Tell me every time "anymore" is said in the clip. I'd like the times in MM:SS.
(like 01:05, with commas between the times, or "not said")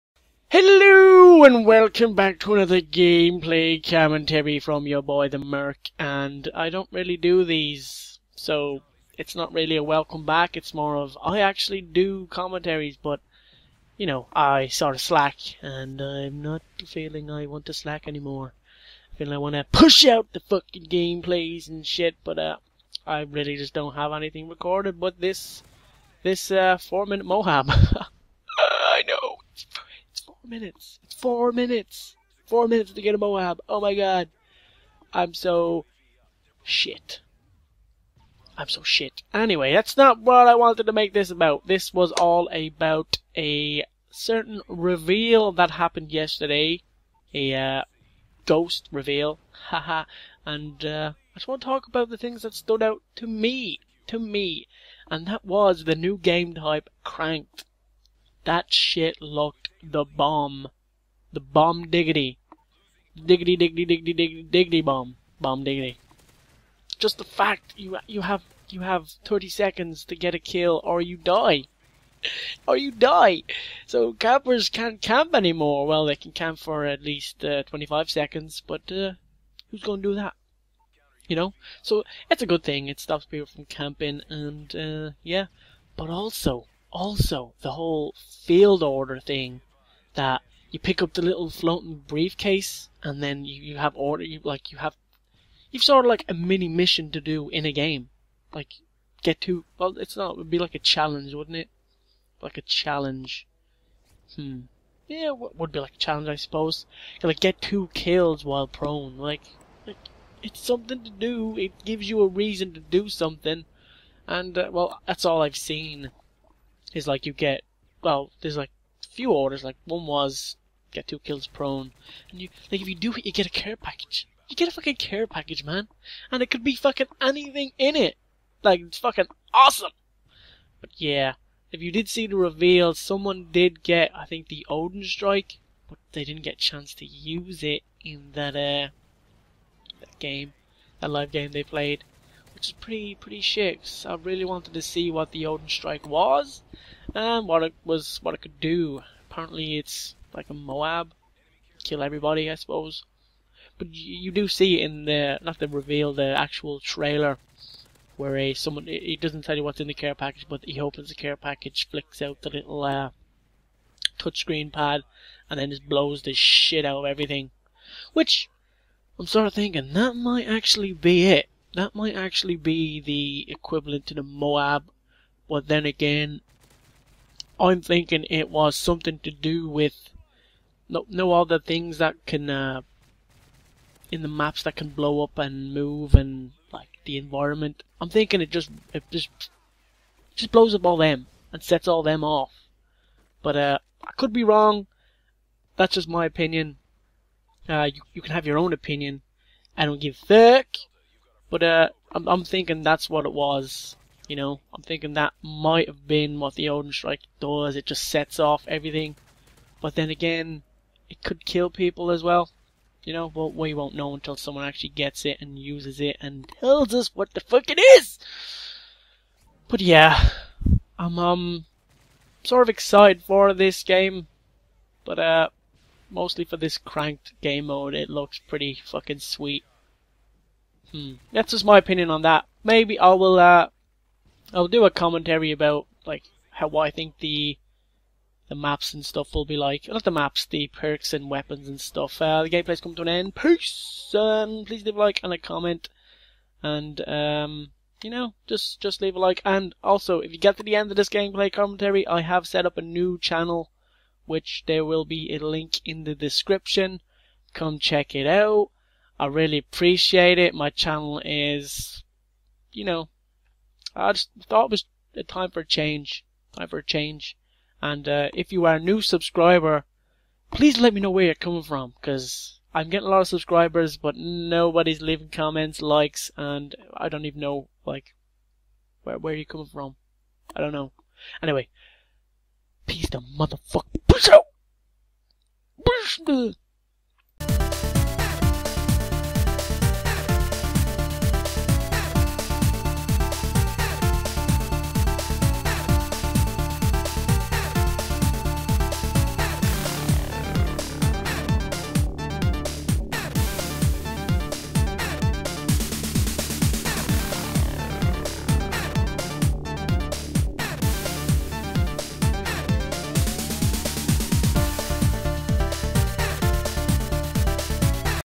00:18, 01:15.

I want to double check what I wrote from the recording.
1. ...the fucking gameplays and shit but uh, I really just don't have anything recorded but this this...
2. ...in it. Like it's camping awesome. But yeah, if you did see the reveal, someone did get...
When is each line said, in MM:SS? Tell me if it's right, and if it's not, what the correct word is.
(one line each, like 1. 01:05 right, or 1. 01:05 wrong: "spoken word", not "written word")
1. 00:20 right
2. 02:07 wrong: "fucking", not "camping".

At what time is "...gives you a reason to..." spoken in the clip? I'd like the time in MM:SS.
01:51.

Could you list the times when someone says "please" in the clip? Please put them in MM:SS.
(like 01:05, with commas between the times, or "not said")
04:04, 04:30.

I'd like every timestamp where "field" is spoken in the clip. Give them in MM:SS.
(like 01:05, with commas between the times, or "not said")
01:28.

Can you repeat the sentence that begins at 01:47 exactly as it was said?
like get two kills while prone.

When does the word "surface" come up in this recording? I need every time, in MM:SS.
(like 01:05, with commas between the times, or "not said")
not said.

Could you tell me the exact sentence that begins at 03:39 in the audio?
But yeah, I'm um sort of excited for this game, but uh mostly for this cranked game mode.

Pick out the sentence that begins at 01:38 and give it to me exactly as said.
Like get to well it's not it would be like a challenge, wouldn't it?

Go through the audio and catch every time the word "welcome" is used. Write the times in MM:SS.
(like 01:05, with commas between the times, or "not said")
00:01, 00:09.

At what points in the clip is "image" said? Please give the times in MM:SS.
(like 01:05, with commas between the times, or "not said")
not said.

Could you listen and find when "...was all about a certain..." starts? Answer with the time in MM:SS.
00:41.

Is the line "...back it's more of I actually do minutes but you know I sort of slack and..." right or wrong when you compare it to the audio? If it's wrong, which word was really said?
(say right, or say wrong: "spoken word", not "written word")
wrong: "commentaries", not "minutes".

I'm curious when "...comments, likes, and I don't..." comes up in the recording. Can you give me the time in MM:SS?
04:35.